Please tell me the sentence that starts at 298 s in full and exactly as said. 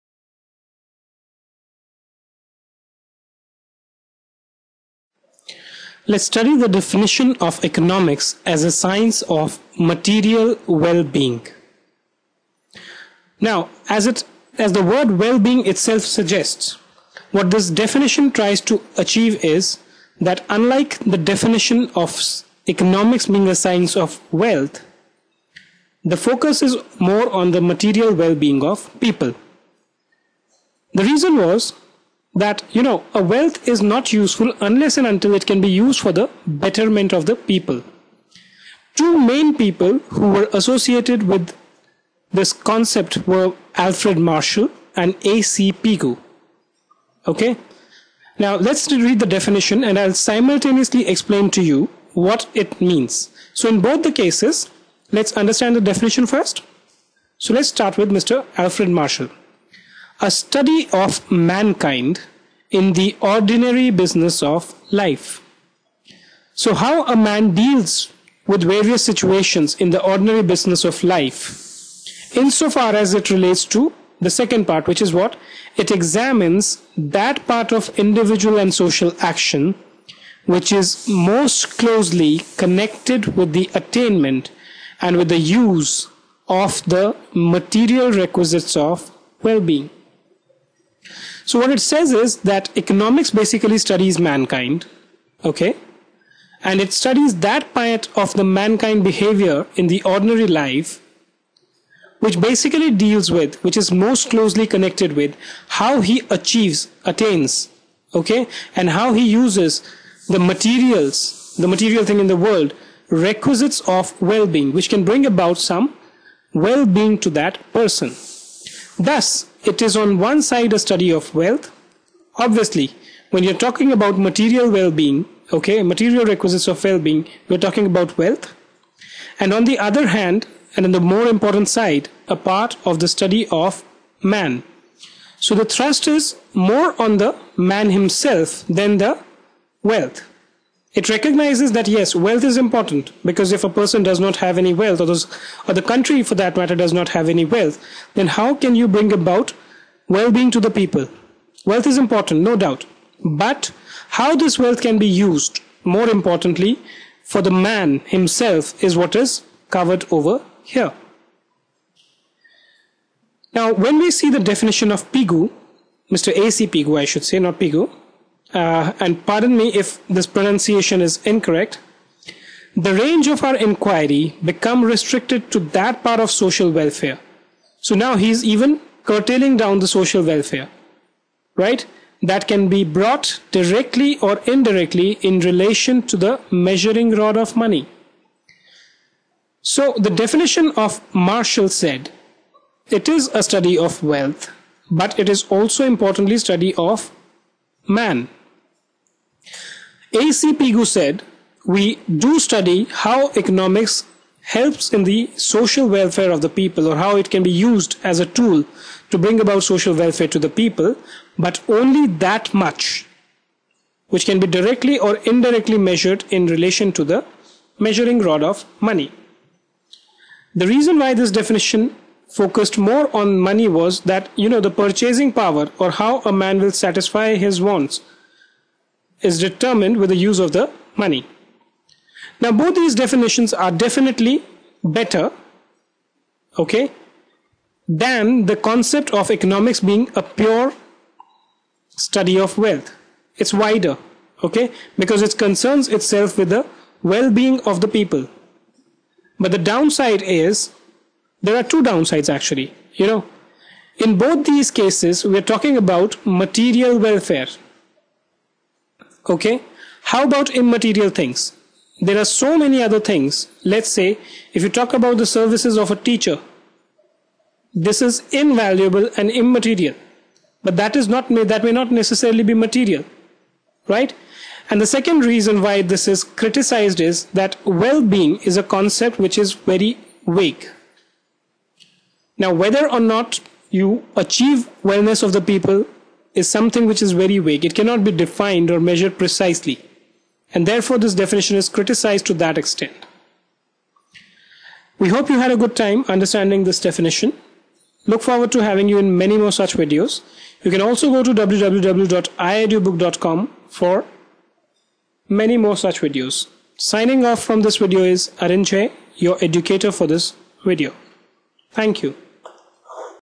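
Look forward to having you in many more such videos.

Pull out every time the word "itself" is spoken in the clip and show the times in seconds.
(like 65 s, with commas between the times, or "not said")
15 s, 245 s.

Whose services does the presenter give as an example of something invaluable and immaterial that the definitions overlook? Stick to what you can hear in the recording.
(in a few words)
Teacher.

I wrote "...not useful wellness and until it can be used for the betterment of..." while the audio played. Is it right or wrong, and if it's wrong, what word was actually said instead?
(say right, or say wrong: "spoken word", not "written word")
wrong: "unless", not "wellness".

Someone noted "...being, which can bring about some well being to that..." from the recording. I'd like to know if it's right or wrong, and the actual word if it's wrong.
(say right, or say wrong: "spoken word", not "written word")
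right.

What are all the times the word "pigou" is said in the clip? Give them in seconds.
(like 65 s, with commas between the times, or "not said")
45 s, 200 s.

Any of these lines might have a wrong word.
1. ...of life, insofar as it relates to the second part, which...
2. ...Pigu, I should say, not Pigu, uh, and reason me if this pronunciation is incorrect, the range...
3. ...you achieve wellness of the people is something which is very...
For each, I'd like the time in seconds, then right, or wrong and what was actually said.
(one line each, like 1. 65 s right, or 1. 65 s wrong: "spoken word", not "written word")
1. 70 s right
2. 166 s wrong: "pardon", not "reason"
3. 283 s right.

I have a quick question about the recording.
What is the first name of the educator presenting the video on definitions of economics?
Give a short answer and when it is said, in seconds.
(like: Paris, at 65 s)
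Arinjay, at 308 s.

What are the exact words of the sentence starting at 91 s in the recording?
So what it says is that economics basically studies mankind, okay?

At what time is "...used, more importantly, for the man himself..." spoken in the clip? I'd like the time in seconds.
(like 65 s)
155 s.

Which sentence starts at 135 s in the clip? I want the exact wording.
So the thrust is more on the man himself than the wealth.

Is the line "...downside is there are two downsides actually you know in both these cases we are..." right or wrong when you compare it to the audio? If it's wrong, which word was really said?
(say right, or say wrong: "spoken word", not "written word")
right.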